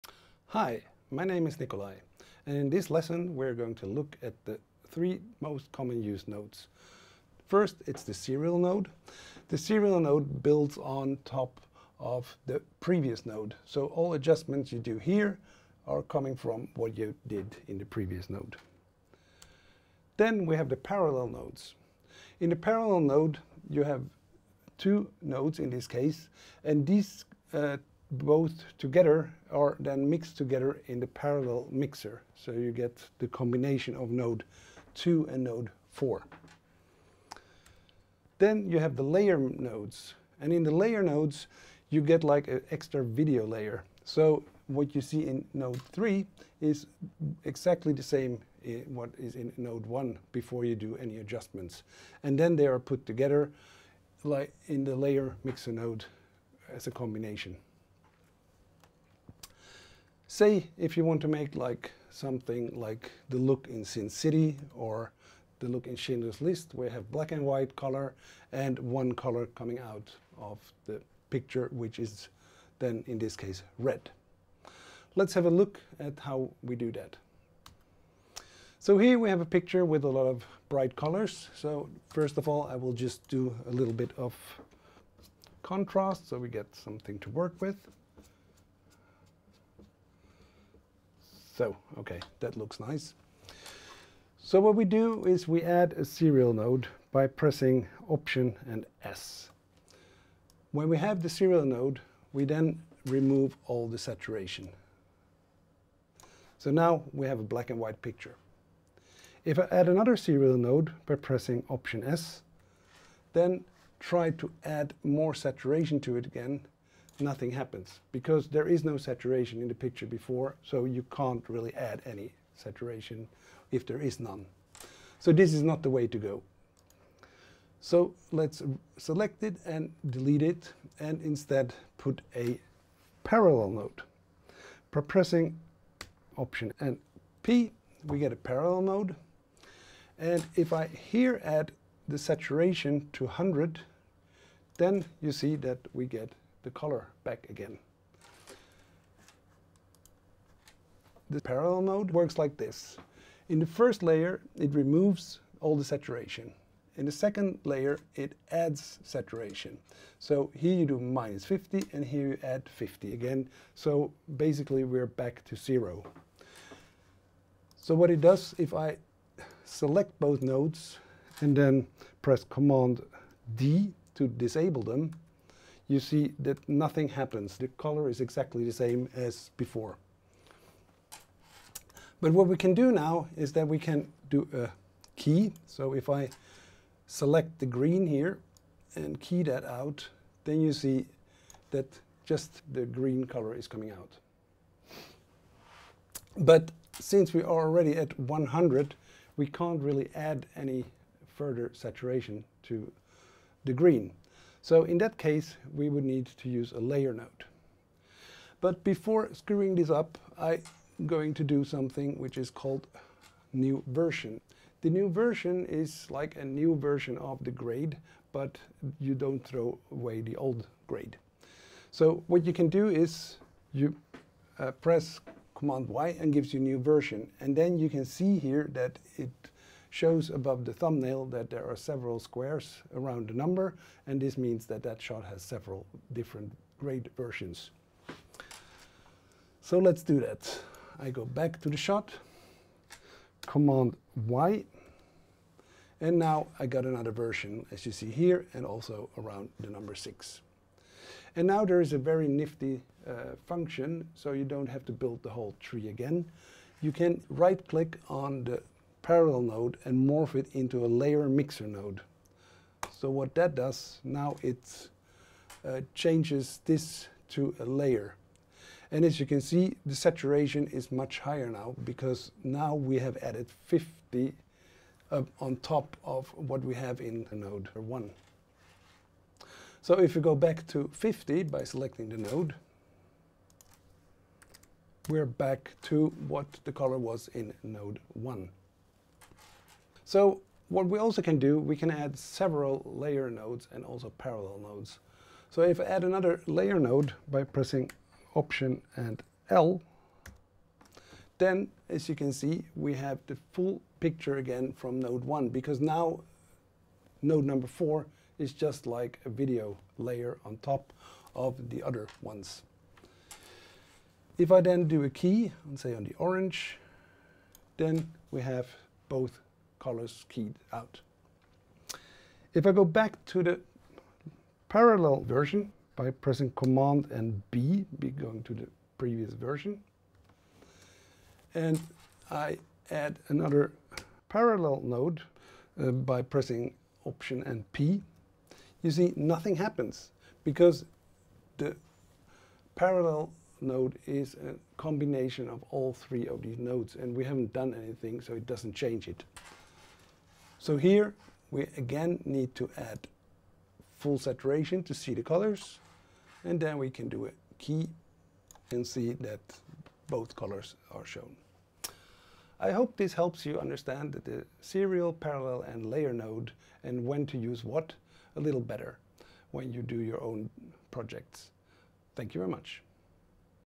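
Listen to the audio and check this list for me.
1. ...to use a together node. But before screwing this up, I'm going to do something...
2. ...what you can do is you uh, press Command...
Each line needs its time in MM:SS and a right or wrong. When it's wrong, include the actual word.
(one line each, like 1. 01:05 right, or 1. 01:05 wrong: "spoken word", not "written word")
1. 03:26 wrong: "layer", not "together"
2. 03:42 right.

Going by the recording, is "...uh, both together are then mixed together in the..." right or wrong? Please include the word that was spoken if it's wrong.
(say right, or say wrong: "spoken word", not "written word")
right.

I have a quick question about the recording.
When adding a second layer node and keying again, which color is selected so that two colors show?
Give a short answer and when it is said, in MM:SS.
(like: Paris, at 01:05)
Orange, at 05:16.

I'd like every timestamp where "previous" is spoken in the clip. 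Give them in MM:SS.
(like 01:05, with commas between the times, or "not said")
00:12, 00:17, 05:28.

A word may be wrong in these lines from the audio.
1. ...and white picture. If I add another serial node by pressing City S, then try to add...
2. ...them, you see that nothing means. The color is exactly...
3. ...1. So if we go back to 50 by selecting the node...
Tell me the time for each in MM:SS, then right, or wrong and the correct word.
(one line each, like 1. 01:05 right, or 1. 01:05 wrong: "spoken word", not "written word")
1. 01:47 wrong: "Option", not "City"
2. 02:54 wrong: "happens", not "means"
3. 04:37 right.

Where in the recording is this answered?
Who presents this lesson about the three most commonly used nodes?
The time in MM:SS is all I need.
00:01.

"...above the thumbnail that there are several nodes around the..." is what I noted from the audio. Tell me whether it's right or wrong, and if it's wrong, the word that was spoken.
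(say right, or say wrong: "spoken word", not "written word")
wrong: "squares", not "nodes".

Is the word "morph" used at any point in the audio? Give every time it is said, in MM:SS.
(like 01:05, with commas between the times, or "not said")
04:20.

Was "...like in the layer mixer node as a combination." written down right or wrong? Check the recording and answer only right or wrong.
right.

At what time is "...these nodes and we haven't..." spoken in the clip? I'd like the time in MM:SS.
05:46.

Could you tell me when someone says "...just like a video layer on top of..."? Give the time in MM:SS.
05:08.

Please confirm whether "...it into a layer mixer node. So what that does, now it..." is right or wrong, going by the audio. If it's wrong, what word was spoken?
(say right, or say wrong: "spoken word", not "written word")
right.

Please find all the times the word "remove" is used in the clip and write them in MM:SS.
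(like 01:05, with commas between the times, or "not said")
01:43, 02:34.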